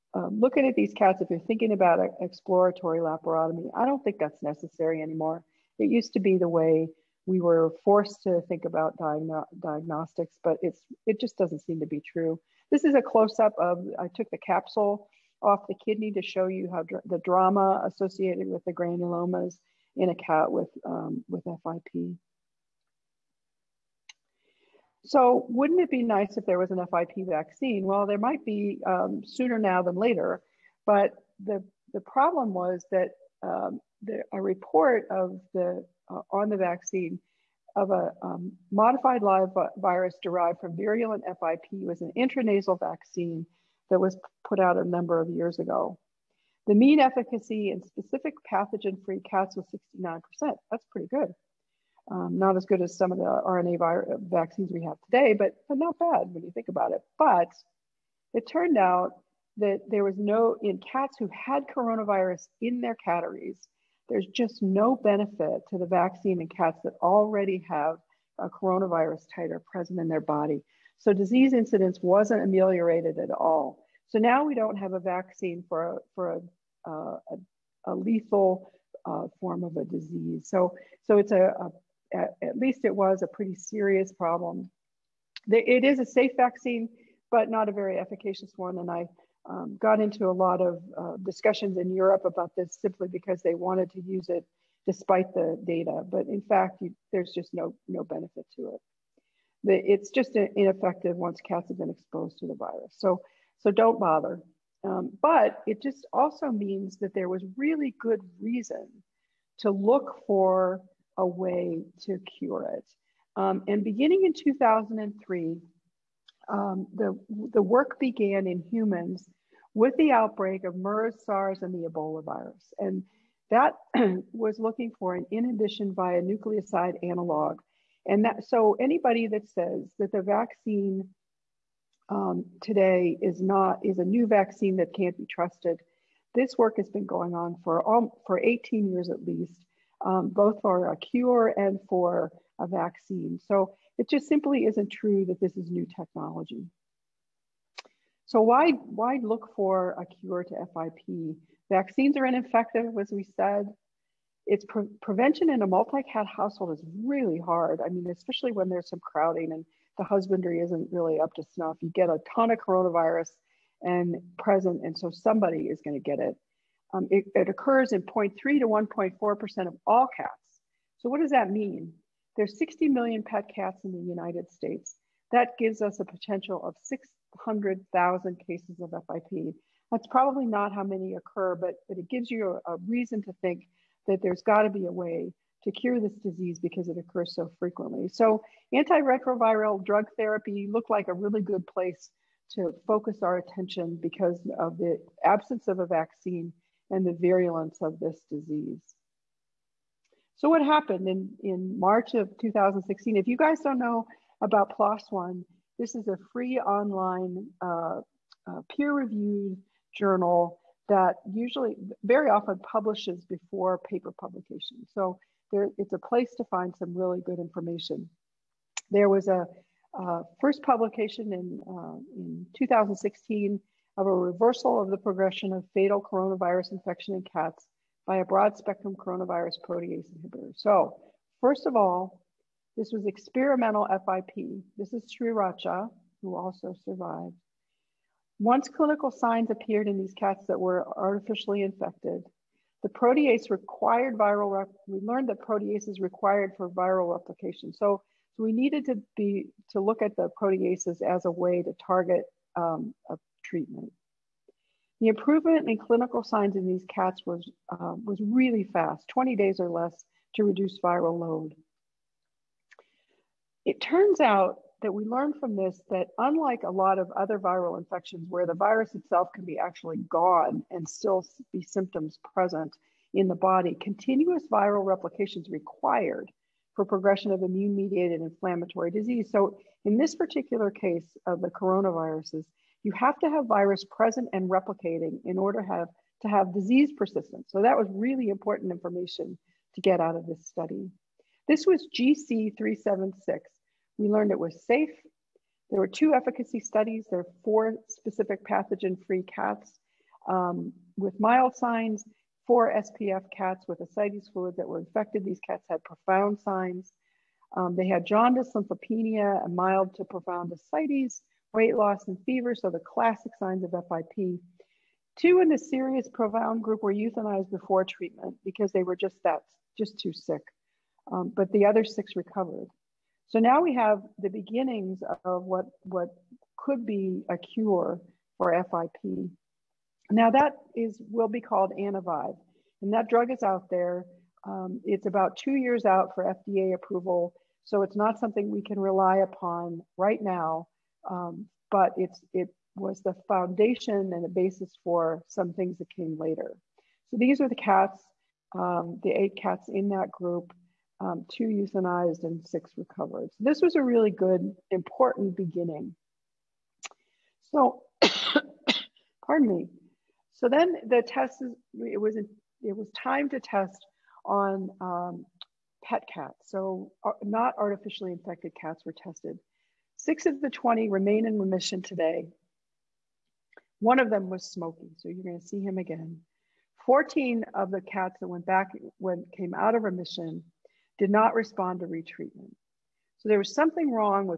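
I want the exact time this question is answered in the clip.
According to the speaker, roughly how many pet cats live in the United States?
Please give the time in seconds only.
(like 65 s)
172 s.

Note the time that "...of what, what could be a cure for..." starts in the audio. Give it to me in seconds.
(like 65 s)
325 s.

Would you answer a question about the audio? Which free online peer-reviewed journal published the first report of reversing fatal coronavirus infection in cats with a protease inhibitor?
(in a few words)
PLOS One.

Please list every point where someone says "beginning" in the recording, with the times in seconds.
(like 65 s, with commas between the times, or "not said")
113 s, 324 s, 355 s.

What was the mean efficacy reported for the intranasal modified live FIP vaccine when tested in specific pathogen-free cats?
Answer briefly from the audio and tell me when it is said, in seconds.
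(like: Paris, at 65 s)
69%, at 49 s.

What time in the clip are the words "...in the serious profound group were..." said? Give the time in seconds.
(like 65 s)
315 s.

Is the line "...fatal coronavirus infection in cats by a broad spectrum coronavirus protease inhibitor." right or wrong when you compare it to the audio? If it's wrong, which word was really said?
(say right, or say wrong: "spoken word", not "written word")
right.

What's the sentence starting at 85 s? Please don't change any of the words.
It is a safe vaccine, but not a very efficacious one.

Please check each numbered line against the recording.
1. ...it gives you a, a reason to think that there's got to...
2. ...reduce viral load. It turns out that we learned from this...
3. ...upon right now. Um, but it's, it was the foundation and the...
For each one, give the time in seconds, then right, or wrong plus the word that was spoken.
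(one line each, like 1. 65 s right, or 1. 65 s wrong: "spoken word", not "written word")
1. 181 s right
2. 260 s right
3. 339 s right.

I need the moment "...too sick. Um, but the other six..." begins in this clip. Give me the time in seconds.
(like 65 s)
319 s.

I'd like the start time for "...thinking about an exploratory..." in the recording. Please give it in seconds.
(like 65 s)
1 s.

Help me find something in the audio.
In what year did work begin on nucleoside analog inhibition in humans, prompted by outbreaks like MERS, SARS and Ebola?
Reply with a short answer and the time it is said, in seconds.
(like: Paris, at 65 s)
2003, at 114 s.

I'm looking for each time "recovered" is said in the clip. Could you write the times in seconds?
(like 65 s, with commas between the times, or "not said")
322 s, 352 s.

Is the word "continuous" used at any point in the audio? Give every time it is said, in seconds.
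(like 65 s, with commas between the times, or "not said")
273 s.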